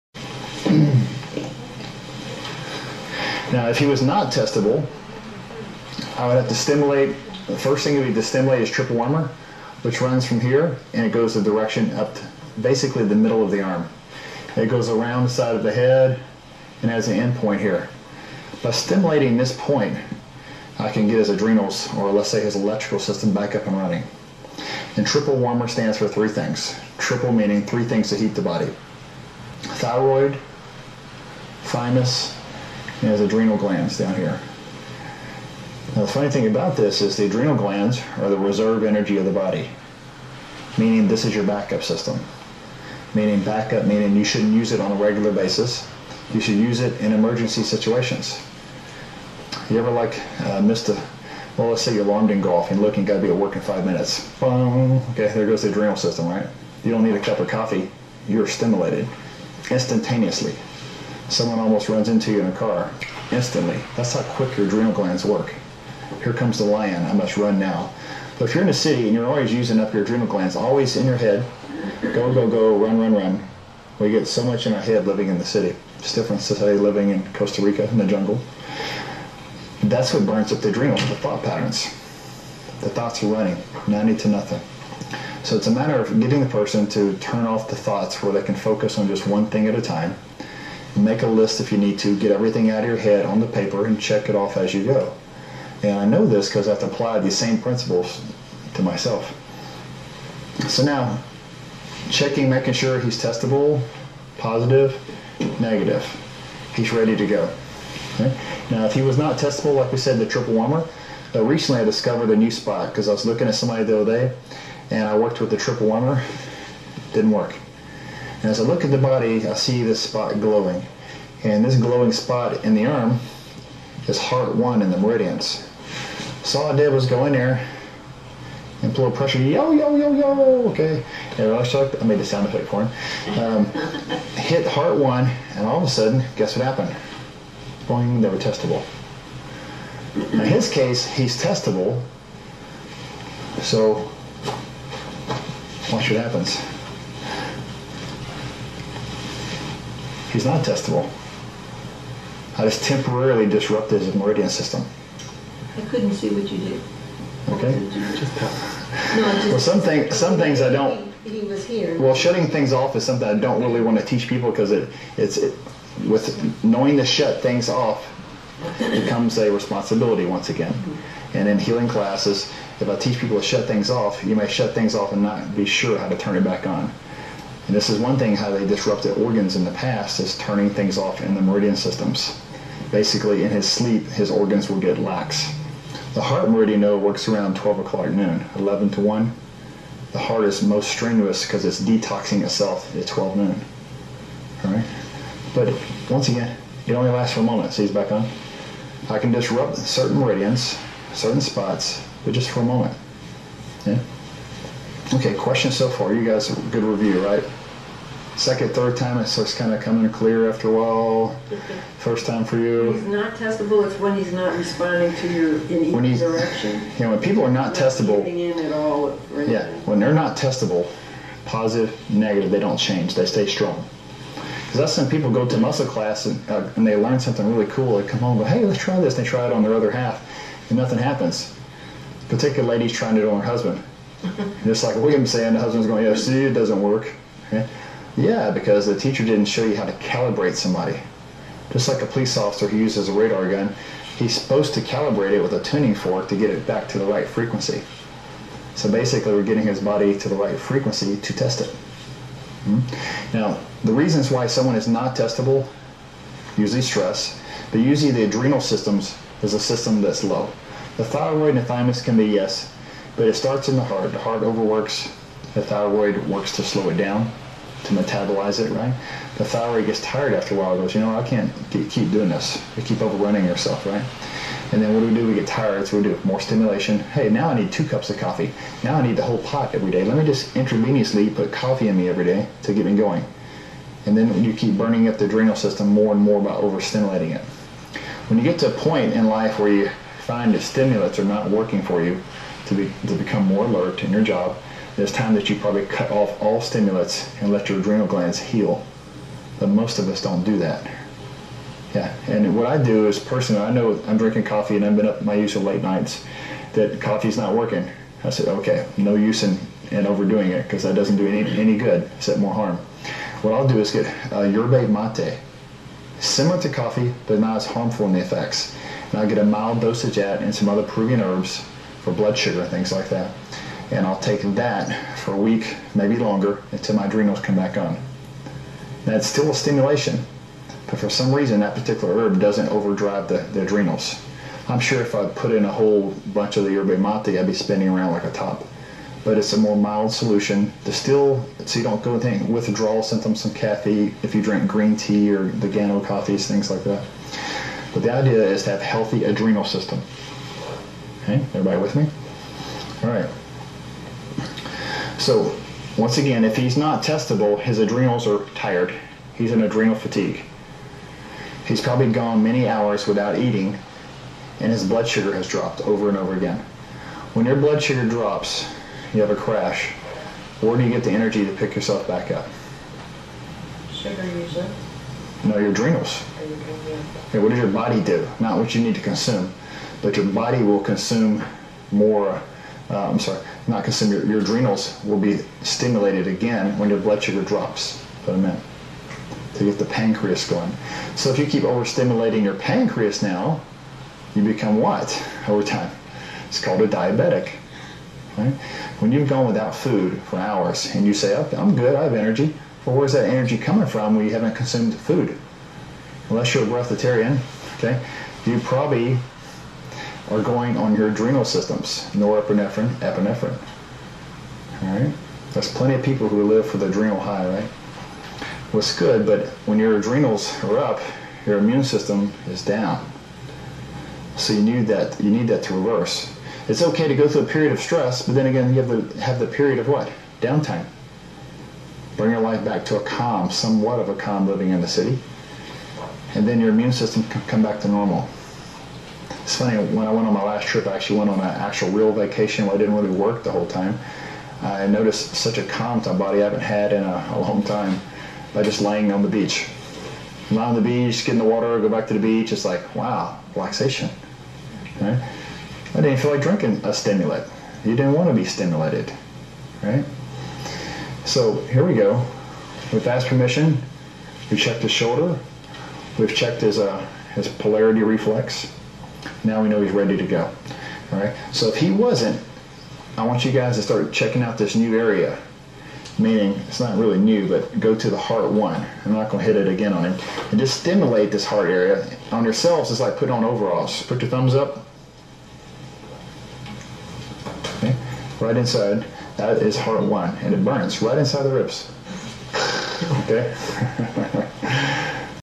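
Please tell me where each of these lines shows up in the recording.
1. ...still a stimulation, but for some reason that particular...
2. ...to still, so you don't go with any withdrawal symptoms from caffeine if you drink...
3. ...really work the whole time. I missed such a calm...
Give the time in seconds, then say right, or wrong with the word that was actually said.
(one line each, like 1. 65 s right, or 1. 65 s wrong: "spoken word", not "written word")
1. 329 s right
2. 340 s right
3. 442 s wrong: "noticed", not "missed".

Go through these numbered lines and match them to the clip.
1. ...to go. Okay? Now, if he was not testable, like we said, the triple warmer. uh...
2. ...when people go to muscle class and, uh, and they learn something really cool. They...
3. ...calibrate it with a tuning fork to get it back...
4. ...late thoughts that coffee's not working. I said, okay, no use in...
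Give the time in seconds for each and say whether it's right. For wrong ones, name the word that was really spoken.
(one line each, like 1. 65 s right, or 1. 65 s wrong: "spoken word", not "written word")
1. 107 s right
2. 224 s right
3. 244 s right
4. 305 s wrong: "nights", not "thoughts".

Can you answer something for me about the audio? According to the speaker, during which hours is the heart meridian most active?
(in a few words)
11 to 1.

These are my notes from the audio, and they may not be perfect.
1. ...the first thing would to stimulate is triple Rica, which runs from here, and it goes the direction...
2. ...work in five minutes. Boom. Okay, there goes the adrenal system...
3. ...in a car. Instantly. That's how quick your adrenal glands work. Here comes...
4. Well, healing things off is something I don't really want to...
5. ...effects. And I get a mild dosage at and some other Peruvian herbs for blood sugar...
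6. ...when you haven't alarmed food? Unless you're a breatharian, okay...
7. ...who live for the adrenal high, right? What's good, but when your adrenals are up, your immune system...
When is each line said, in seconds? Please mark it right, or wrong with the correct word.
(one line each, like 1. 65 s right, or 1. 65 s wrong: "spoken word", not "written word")
1. 7 s wrong: "Warmer", not "Rica"
2. 53 s right
3. 62 s right
4. 161 s wrong: "shutting", not "healing"
5. 318 s right
6. 404 s wrong: "consumed", not "alarmed"
7. 416 s right.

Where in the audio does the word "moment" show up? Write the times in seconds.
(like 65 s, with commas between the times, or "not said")
197 s, 202 s.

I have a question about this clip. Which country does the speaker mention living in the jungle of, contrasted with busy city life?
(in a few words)
Costa Rica.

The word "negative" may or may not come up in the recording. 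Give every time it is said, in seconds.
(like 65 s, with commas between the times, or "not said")
105 s, 222 s.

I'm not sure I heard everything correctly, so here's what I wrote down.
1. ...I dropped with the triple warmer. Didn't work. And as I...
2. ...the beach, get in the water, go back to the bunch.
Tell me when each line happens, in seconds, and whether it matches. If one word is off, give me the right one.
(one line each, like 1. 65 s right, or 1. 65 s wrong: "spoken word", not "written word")
1. 115 s wrong: "worked", not "dropped"
2. 450 s wrong: "beach", not "bunch".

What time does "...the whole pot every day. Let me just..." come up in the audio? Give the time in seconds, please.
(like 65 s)
279 s.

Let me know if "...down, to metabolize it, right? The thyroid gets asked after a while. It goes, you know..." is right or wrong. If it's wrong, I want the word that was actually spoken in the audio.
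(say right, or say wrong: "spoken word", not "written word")
wrong: "tired", not "asked".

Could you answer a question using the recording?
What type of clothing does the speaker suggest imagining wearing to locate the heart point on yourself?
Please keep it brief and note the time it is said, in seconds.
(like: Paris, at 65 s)
Overalls, at 483 s.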